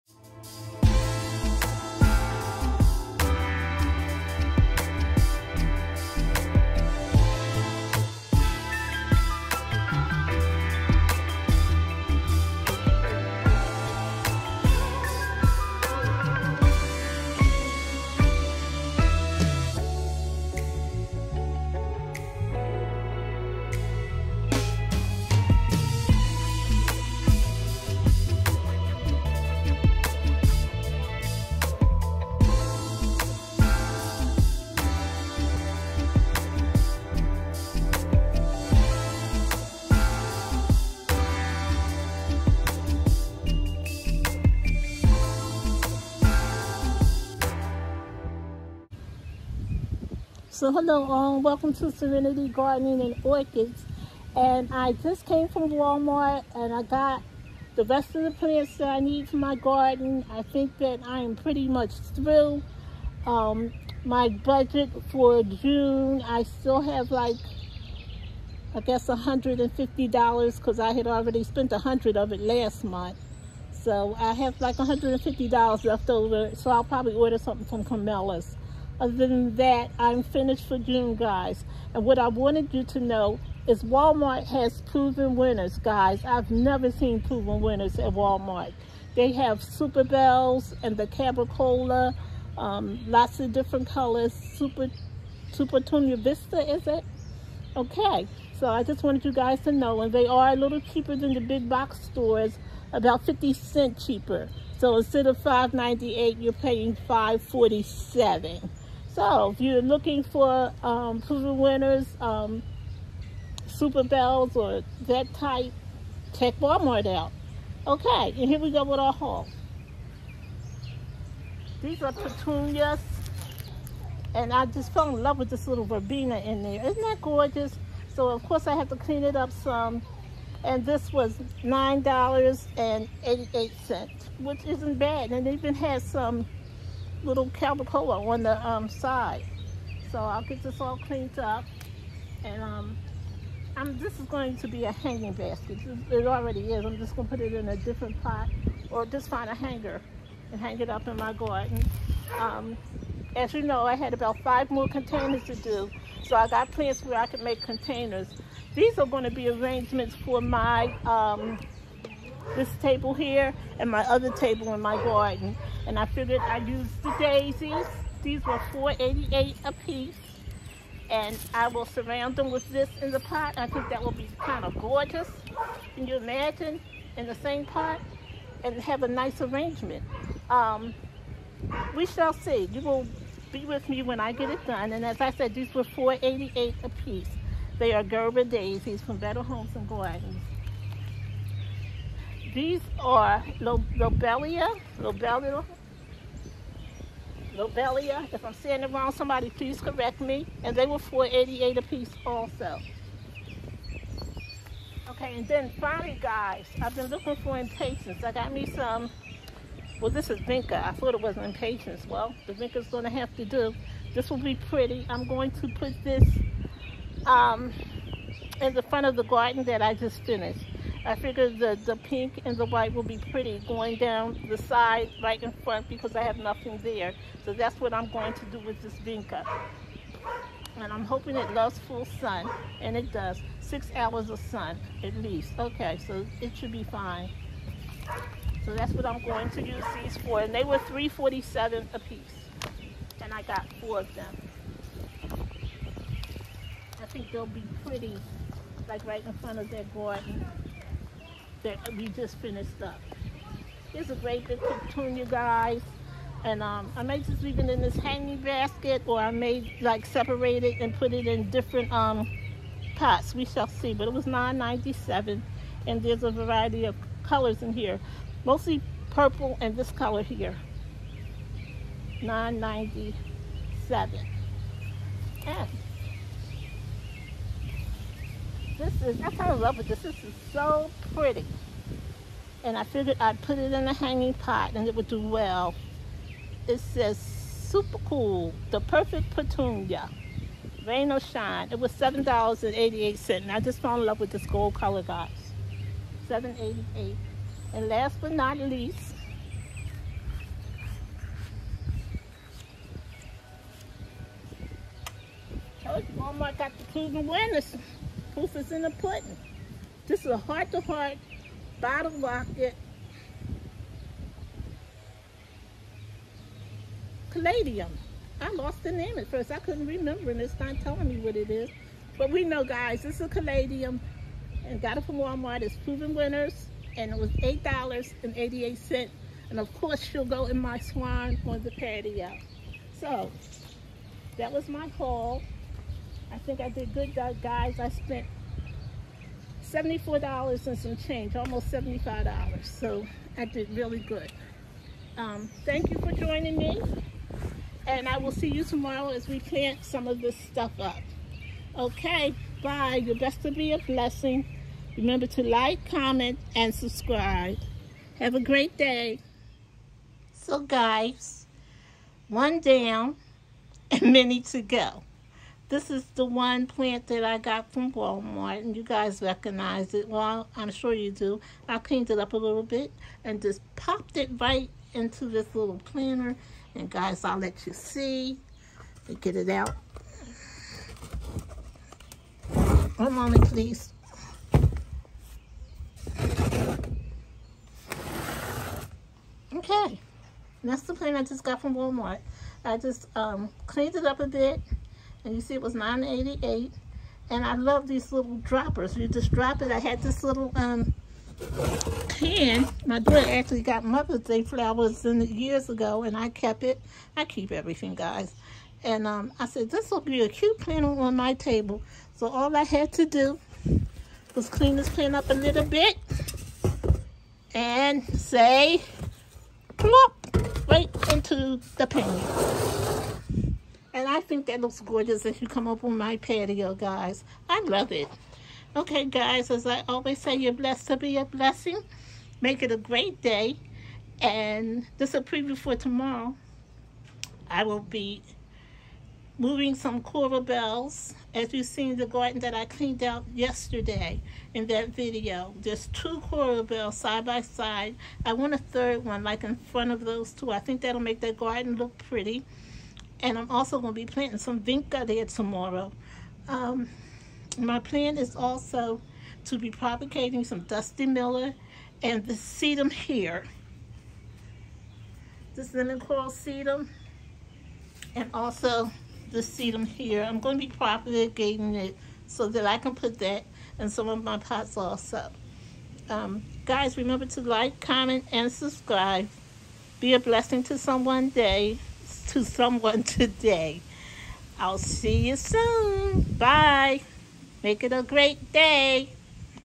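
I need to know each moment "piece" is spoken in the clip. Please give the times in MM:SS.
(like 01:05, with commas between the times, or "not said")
02:49, 03:07, 03:21, 04:01.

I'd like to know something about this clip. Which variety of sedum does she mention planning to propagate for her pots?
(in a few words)
lemon coral.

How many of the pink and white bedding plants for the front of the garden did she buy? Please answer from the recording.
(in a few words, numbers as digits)
4.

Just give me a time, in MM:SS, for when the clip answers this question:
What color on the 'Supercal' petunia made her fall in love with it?
04:54.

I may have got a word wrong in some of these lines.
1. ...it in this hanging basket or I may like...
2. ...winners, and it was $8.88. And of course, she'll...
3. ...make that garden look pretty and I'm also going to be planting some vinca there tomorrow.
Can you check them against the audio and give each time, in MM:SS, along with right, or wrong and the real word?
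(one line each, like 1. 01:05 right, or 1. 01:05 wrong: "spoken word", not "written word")
1. 04:17 right
2. 05:26 right
3. 07:31 right.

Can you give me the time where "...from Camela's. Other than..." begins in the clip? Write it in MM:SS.
01:17.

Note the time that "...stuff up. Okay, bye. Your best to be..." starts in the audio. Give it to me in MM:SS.
05:50.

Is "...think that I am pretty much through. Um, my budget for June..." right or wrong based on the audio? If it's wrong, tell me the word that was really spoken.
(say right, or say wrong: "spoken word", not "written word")
right.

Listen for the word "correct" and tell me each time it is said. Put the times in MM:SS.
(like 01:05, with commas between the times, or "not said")
03:19.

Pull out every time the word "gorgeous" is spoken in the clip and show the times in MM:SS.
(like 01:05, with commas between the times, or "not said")
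02:07, 02:54, 07:04.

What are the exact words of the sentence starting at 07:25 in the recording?
There's two coral bells side by side.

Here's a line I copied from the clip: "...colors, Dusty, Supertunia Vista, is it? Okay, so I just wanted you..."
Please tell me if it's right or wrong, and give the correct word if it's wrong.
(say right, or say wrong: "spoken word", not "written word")
wrong: "Super", not "Dusty".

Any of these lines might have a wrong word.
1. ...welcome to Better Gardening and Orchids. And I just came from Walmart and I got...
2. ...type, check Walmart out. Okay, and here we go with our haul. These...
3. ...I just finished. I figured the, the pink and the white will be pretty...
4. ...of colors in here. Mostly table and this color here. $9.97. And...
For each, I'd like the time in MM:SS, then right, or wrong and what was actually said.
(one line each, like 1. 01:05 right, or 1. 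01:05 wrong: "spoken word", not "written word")
1. 00:51 wrong: "Serenity", not "Better"
2. 01:55 right
3. 03:39 right
4. 04:26 wrong: "purple", not "table".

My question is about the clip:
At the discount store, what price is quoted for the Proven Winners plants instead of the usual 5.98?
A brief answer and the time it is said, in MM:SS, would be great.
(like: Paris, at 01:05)
$5.47, at 01:47.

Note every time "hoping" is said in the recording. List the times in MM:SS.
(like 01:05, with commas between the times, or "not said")
03:51.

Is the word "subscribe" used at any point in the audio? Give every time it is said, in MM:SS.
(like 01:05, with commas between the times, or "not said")
05:56, 07:58.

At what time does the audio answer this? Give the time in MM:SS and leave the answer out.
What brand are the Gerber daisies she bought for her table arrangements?
03:09.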